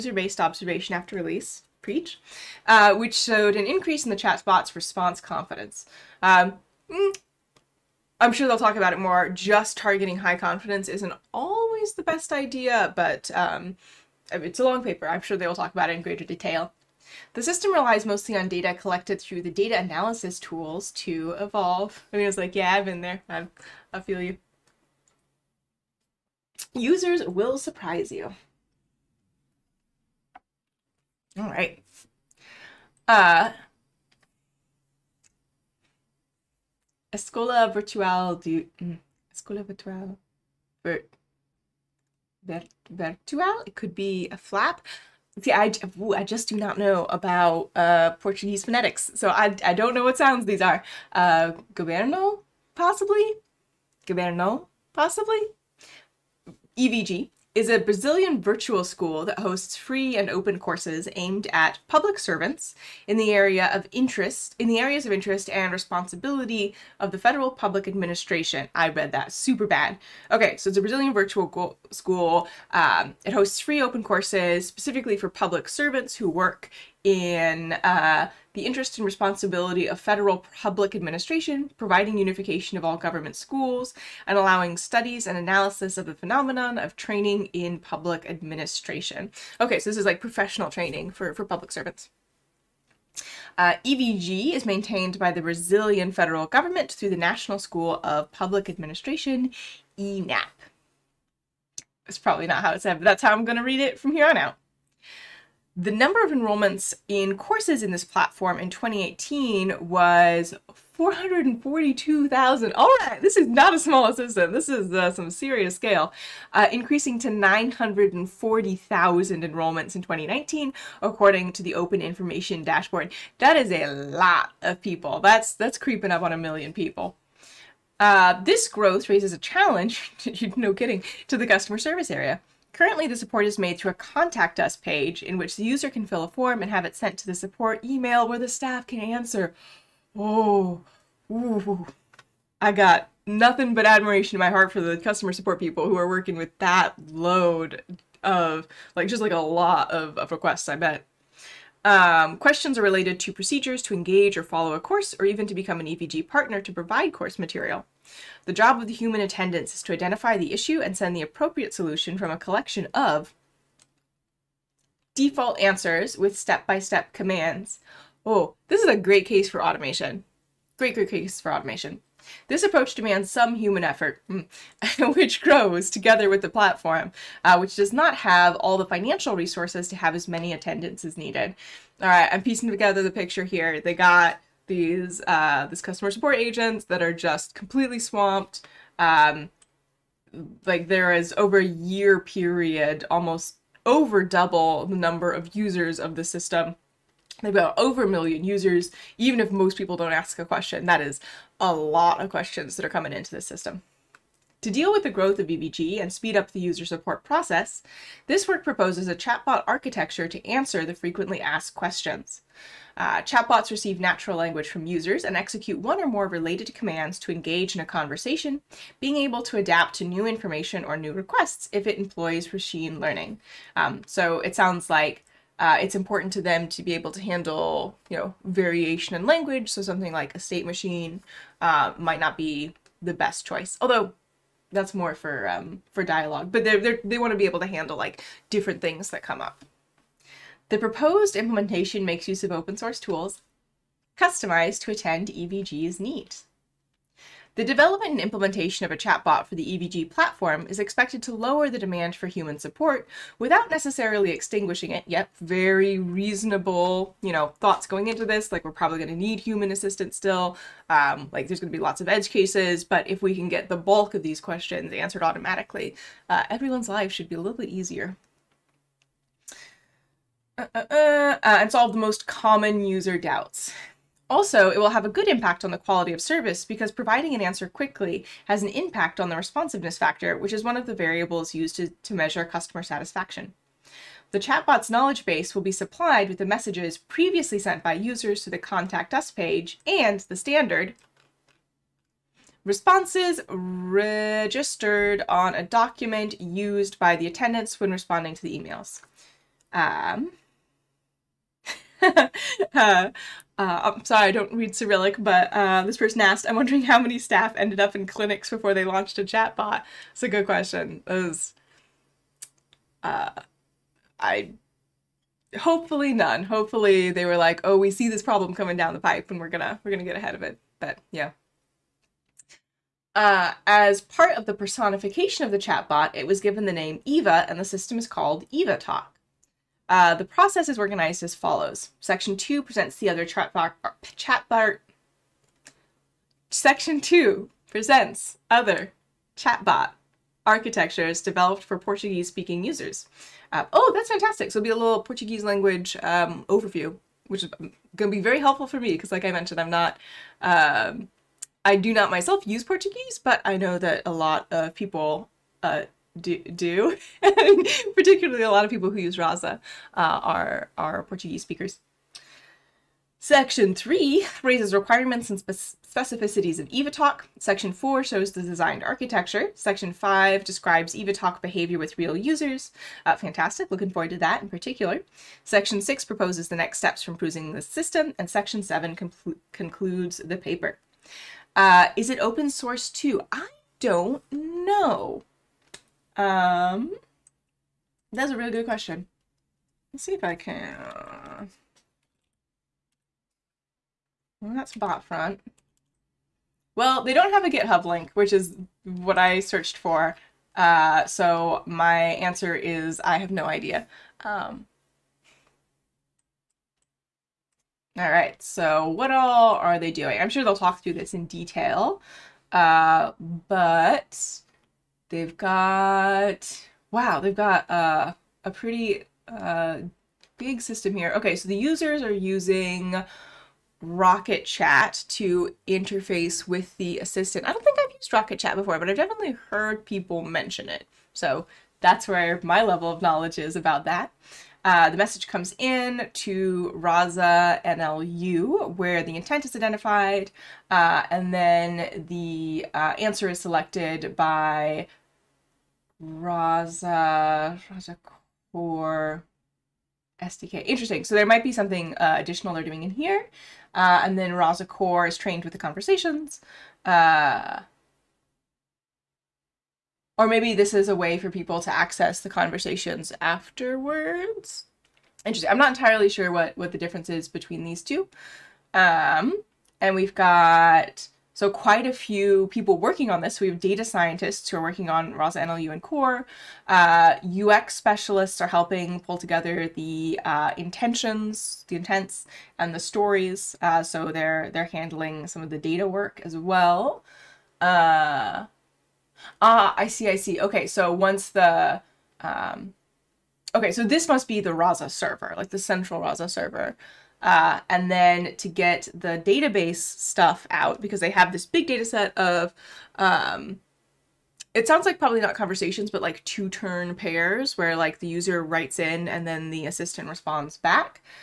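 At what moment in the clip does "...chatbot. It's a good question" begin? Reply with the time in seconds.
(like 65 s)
309 s.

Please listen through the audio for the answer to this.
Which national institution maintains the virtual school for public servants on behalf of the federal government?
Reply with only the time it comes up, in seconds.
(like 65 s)
97 s.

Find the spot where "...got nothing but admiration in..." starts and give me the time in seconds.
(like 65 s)
142 s.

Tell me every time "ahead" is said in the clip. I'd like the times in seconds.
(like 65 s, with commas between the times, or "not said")
320 s.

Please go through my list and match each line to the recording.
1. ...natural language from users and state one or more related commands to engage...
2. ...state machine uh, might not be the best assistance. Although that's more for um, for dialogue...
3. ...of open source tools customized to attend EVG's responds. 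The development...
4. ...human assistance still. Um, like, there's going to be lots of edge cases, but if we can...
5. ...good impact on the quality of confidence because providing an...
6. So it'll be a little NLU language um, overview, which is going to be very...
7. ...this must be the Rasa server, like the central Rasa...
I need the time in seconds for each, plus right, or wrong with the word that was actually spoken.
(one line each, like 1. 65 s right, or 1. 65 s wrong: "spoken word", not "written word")
1. 213 s wrong: "execute", not "state"
2. 230 s wrong: "choice", not "assistance"
3. 242 s wrong: "needs", not "responds"
4. 259 s right
5. 275 s wrong: "service", not "confidence"
6. 344 s wrong: "Portuguese", not "NLU"
7. 493 s right.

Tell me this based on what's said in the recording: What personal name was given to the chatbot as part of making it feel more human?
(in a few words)
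Eva.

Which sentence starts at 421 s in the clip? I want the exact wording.
Okay, so the users are using Rocket Chat to interface with the assistant.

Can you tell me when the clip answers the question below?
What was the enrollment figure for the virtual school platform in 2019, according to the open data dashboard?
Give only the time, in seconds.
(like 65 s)
117 s.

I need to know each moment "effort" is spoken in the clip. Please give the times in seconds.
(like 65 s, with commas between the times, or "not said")
173 s.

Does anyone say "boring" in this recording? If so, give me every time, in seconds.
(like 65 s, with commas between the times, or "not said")
not said.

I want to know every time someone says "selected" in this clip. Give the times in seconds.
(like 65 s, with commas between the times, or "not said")
443 s.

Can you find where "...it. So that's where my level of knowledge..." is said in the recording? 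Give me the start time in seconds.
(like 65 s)
430 s.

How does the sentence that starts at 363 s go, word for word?
Section 3 raises requirements and specificities of EvaTalk.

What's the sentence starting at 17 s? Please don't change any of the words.
The system relies mostly on data collected through the data analysis tools to evolve.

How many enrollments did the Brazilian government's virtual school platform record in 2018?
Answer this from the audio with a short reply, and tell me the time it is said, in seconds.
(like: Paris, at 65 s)
442,000, at 110 s.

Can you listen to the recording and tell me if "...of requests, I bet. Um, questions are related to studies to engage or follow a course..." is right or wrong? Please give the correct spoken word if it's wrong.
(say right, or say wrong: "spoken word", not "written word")
wrong: "procedures", not "studies".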